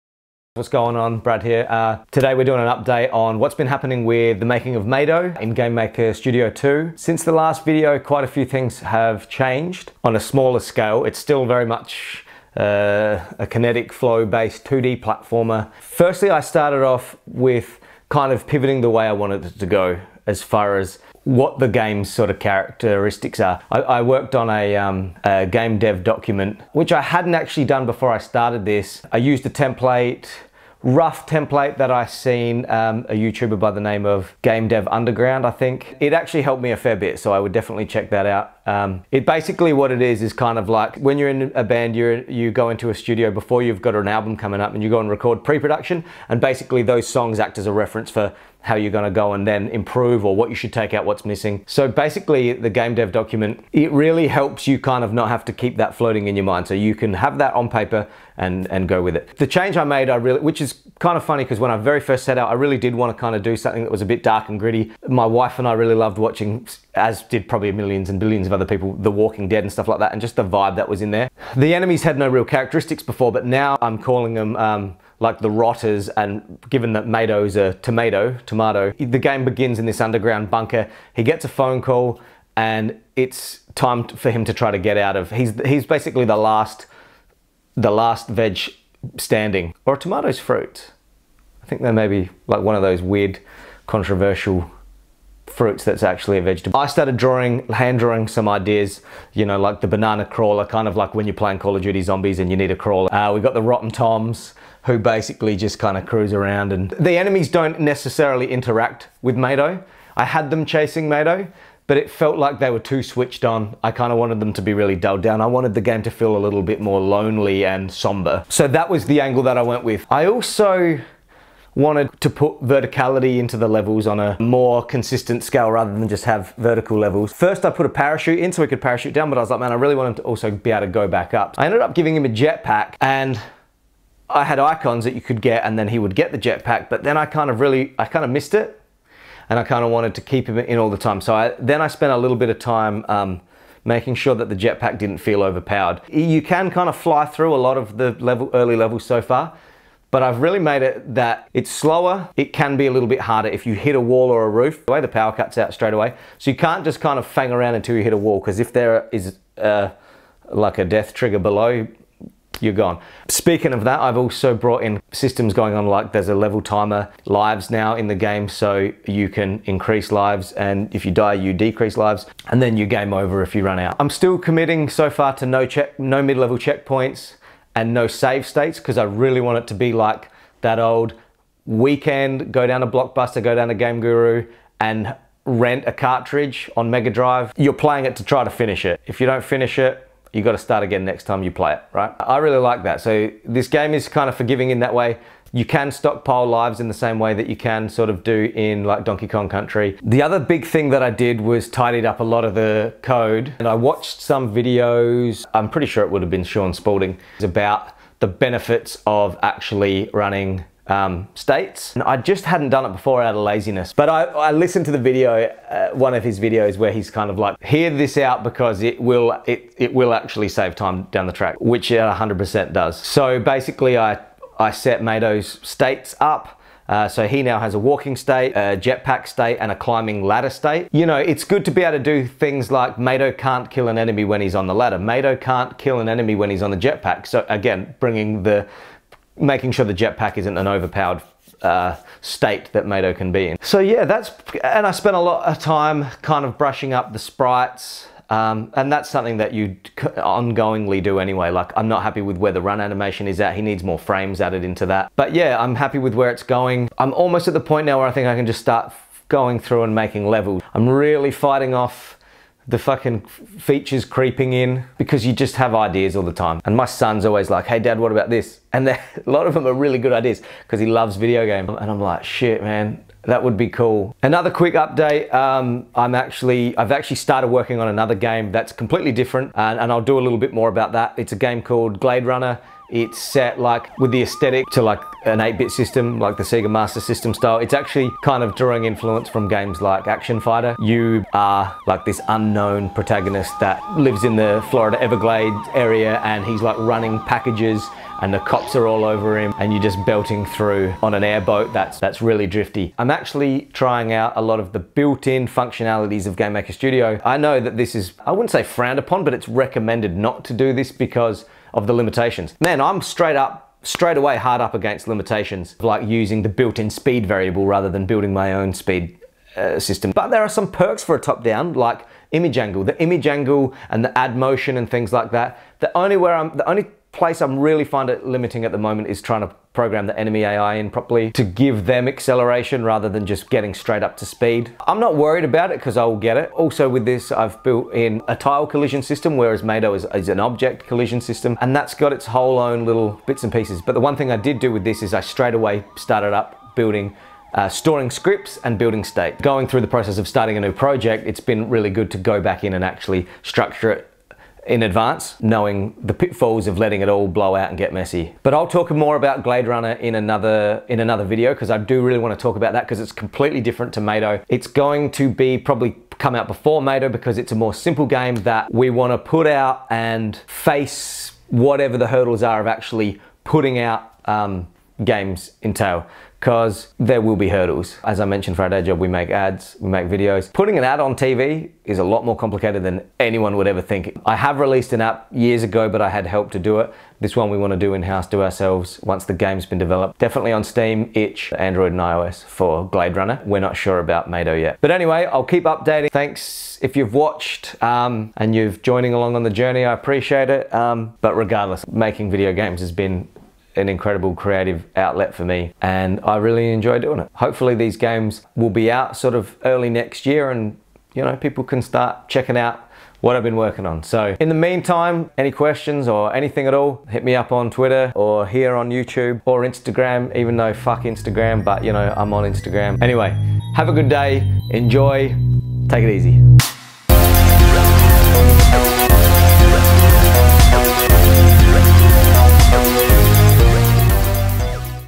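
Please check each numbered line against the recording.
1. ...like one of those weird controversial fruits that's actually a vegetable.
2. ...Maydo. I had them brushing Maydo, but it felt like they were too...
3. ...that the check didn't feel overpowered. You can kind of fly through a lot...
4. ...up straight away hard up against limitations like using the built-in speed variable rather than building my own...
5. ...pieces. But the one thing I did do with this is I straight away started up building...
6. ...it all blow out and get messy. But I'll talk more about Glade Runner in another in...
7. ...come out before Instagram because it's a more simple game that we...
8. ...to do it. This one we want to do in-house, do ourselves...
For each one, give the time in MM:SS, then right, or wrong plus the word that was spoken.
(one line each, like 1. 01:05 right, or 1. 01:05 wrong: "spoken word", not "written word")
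1. 01:32 right
2. 01:49 wrong: "chasing", not "brushing"
3. 02:24 wrong: "jetpack", not "check"
4. 05:13 right
5. 05:43 right
6. 05:57 right
7. 06:06 wrong: "Maydo", not "Instagram"
8. 06:26 right.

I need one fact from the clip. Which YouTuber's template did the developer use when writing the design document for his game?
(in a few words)
Game Dev Underground.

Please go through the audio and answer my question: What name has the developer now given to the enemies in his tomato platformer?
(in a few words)
the rotters.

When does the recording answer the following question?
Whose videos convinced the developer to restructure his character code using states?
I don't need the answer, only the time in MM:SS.
03:26.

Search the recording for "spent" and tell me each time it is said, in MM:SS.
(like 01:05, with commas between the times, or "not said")
02:21, 04:04.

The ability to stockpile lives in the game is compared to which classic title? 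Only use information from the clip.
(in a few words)
Donkey Kong Country.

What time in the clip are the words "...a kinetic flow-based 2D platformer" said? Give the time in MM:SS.
00:13.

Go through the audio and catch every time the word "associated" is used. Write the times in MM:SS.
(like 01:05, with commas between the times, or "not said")
not said.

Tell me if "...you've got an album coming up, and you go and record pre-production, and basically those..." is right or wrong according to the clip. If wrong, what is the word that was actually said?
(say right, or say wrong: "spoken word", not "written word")
right.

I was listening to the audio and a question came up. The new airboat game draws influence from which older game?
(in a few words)
Action Fighter.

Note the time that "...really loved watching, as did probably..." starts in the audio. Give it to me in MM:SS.
01:05.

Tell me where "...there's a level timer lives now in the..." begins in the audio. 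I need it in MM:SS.
02:46.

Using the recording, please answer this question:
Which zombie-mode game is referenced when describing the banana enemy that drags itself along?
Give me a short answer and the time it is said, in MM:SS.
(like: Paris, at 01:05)
Call of Duty Zombies, at 01:41.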